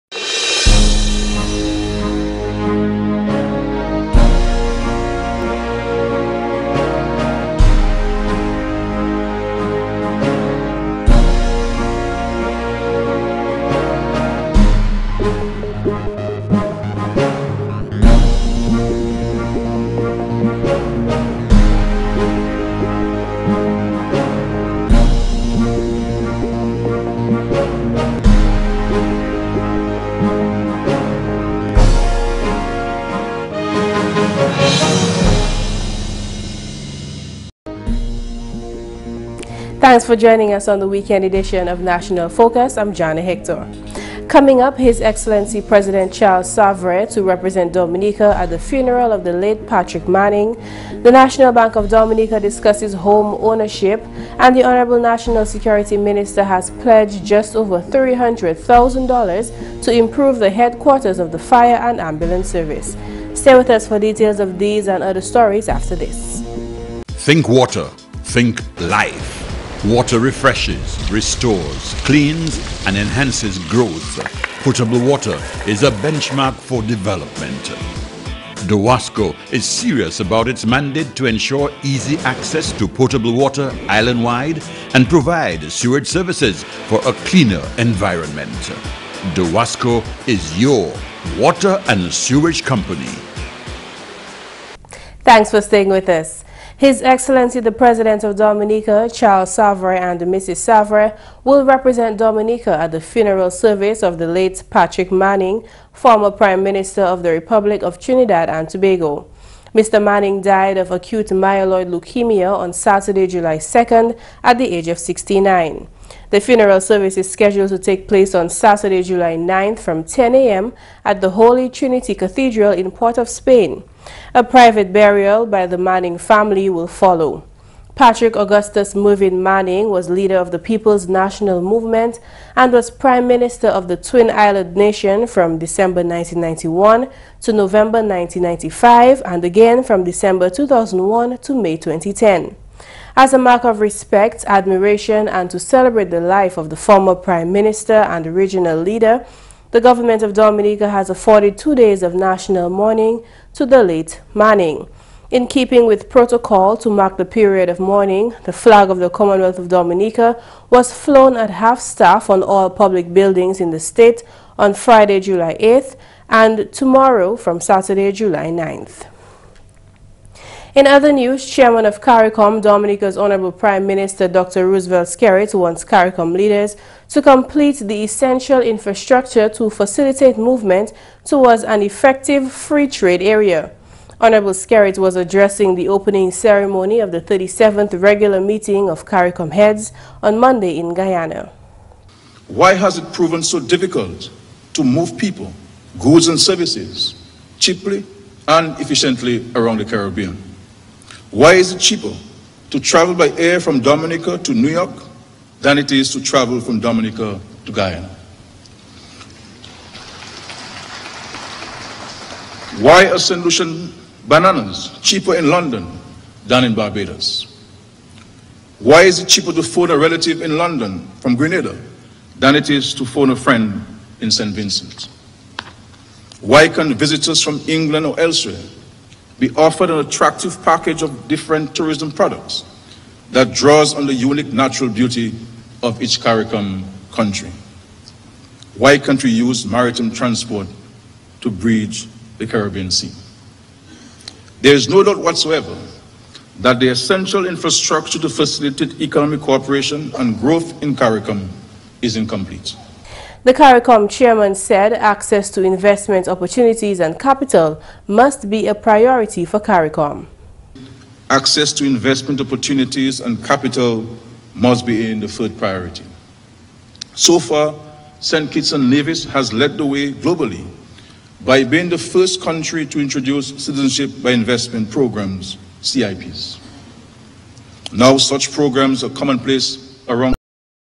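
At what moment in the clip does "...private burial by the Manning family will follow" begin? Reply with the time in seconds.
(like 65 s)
124 s.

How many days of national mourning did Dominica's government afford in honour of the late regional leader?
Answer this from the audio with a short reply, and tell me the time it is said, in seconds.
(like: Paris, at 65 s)
2, at 151 s.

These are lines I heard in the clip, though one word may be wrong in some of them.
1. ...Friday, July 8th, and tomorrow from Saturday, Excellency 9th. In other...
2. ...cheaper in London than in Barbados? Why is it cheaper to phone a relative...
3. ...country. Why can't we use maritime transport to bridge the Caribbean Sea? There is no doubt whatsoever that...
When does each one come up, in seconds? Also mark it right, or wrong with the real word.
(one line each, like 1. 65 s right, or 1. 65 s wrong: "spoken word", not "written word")
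1. 164 s wrong: "July", not "Excellency"
2. 215 s right
3. 237 s right.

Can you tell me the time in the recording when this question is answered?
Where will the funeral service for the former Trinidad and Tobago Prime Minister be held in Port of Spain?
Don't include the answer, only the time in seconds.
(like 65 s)
121 s.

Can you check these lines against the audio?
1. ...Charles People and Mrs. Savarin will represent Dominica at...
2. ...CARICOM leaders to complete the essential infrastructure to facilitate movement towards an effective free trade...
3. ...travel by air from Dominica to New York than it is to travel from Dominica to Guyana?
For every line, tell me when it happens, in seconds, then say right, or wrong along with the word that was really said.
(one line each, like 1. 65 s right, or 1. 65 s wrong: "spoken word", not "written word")
1. 99 s wrong: "Savarin", not "People"
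2. 175 s right
3. 202 s right.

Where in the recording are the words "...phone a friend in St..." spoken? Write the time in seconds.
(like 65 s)
223 s.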